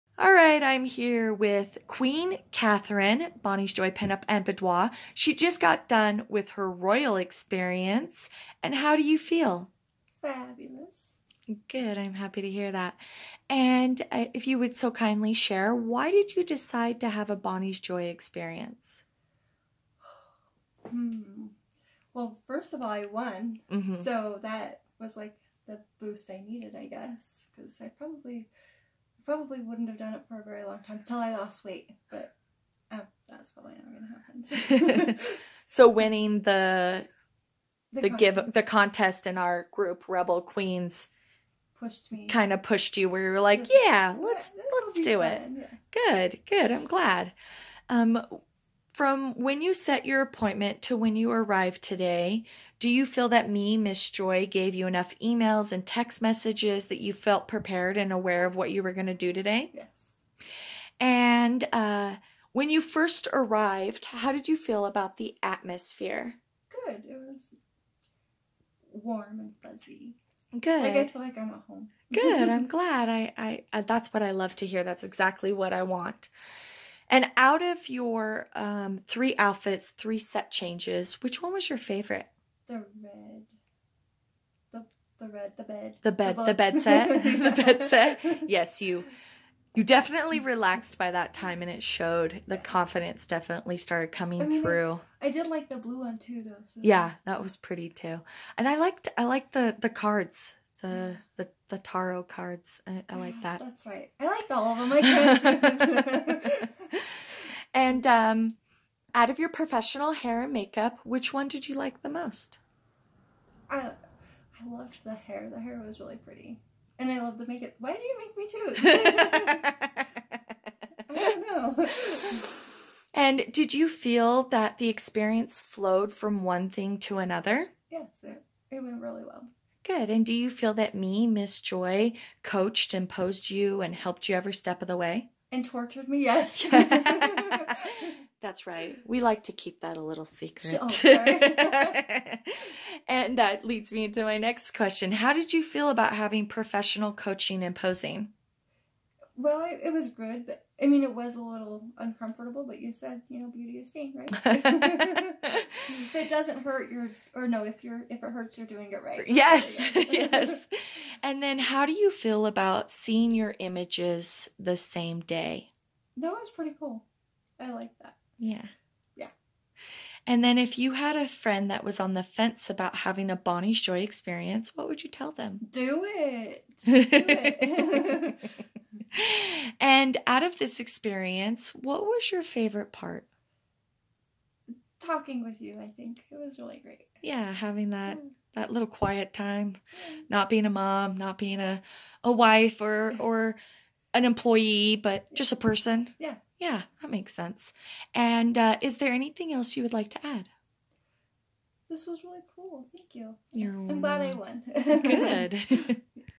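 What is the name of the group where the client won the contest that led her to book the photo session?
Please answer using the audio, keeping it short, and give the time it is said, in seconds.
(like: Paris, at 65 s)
Rebel Queens, at 40 s.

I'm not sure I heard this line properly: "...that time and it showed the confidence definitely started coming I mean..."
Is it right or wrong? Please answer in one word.
right.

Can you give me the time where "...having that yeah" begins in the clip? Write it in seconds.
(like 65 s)
187 s.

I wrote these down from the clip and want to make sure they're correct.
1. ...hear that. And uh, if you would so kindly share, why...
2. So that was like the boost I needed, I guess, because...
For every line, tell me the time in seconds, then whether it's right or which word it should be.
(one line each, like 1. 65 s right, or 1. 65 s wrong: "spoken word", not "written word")
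1. 12 s right
2. 23 s right.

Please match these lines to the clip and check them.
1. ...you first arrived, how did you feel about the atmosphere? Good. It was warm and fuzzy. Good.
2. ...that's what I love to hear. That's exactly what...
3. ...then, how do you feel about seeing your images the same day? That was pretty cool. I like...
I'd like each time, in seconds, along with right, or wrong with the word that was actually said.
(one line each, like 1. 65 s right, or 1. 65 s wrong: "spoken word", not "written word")
1. 62 s right
2. 73 s right
3. 161 s right.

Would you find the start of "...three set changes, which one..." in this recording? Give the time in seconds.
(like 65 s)
79 s.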